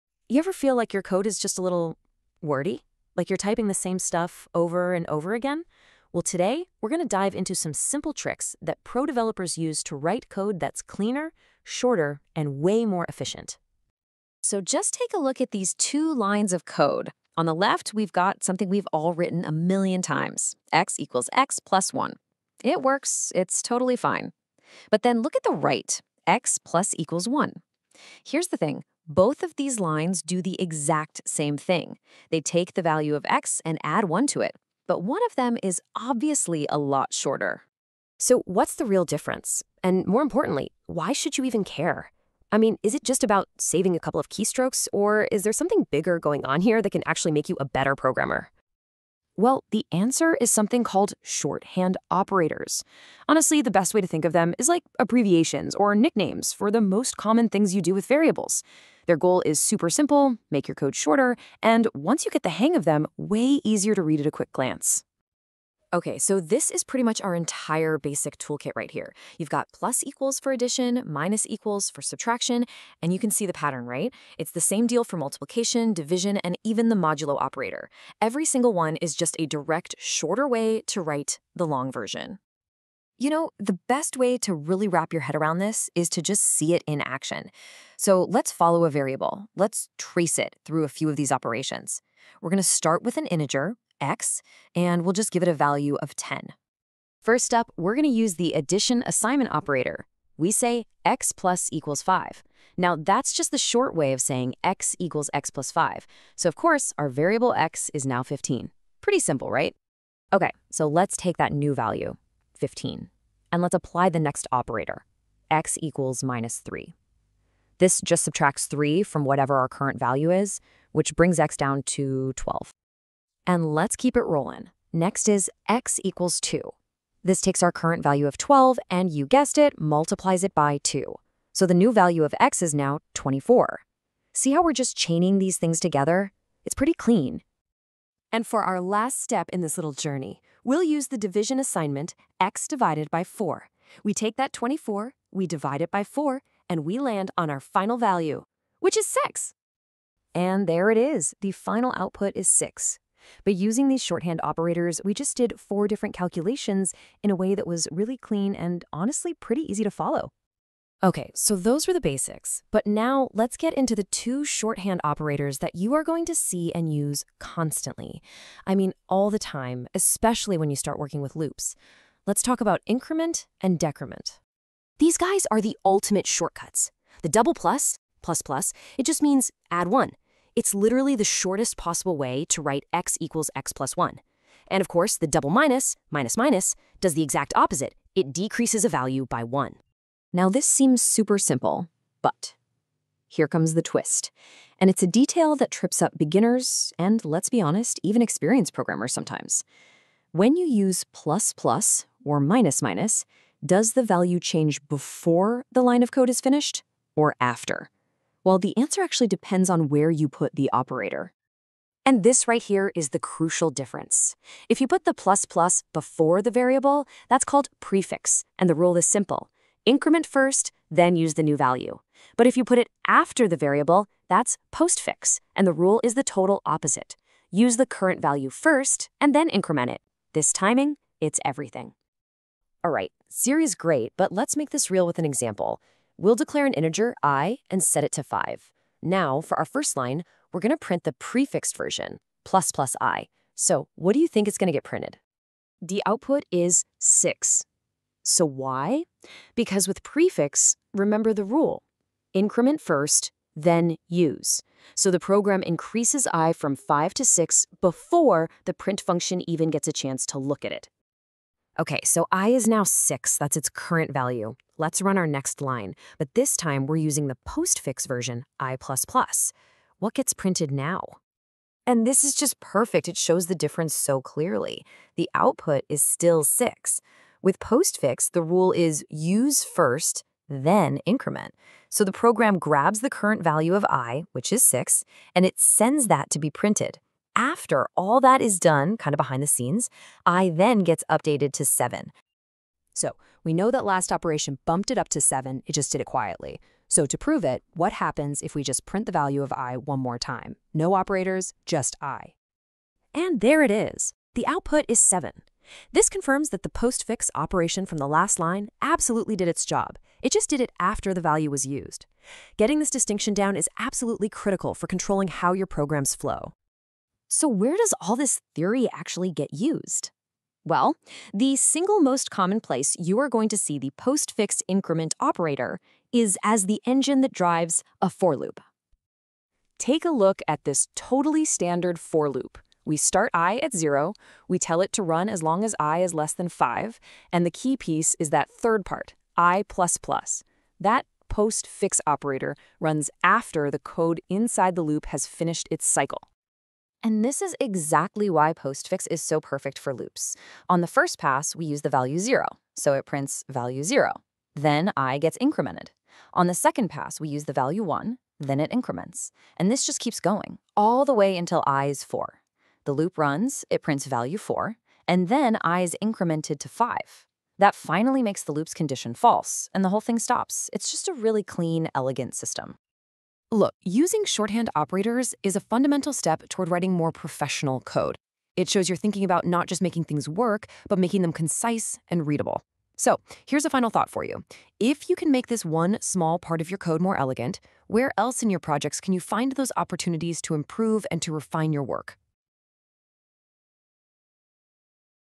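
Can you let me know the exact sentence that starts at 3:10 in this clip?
Now this seems super simple, but here comes the twist.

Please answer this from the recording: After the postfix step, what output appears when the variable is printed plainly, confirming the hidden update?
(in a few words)
7.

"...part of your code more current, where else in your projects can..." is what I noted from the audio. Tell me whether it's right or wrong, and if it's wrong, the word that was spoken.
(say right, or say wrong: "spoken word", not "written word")
wrong: "elegant", not "current".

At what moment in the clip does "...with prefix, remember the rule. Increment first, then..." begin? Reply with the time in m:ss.
4:09.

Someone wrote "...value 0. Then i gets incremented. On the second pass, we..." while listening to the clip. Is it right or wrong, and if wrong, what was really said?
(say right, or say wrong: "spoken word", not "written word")
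right.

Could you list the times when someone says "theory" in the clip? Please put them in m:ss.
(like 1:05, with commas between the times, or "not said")
3:53, 5:18.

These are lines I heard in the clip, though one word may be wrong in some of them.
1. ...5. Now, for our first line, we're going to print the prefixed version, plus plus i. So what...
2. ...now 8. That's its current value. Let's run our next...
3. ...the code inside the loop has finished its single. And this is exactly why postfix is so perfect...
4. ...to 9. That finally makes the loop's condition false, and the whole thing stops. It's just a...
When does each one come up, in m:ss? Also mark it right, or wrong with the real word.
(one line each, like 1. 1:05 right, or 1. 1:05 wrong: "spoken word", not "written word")
1. 3:58 right
2. 4:22 wrong: "6", not "8"
3. 5:43 wrong: "cycle", not "single"
4. 6:06 wrong: "5", not "9".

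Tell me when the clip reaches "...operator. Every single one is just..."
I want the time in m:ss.
1:17.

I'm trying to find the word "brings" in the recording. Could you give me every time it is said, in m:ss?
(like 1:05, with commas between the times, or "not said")
2:01.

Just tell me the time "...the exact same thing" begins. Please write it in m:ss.
0:30.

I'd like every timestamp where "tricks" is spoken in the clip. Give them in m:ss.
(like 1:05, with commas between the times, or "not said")
0:08.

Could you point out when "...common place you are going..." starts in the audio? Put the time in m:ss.
5:22.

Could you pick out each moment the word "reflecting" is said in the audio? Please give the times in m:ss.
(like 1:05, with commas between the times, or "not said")
not said.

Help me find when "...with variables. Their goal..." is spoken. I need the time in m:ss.
0:57.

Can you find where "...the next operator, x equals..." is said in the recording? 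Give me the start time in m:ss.
1:54.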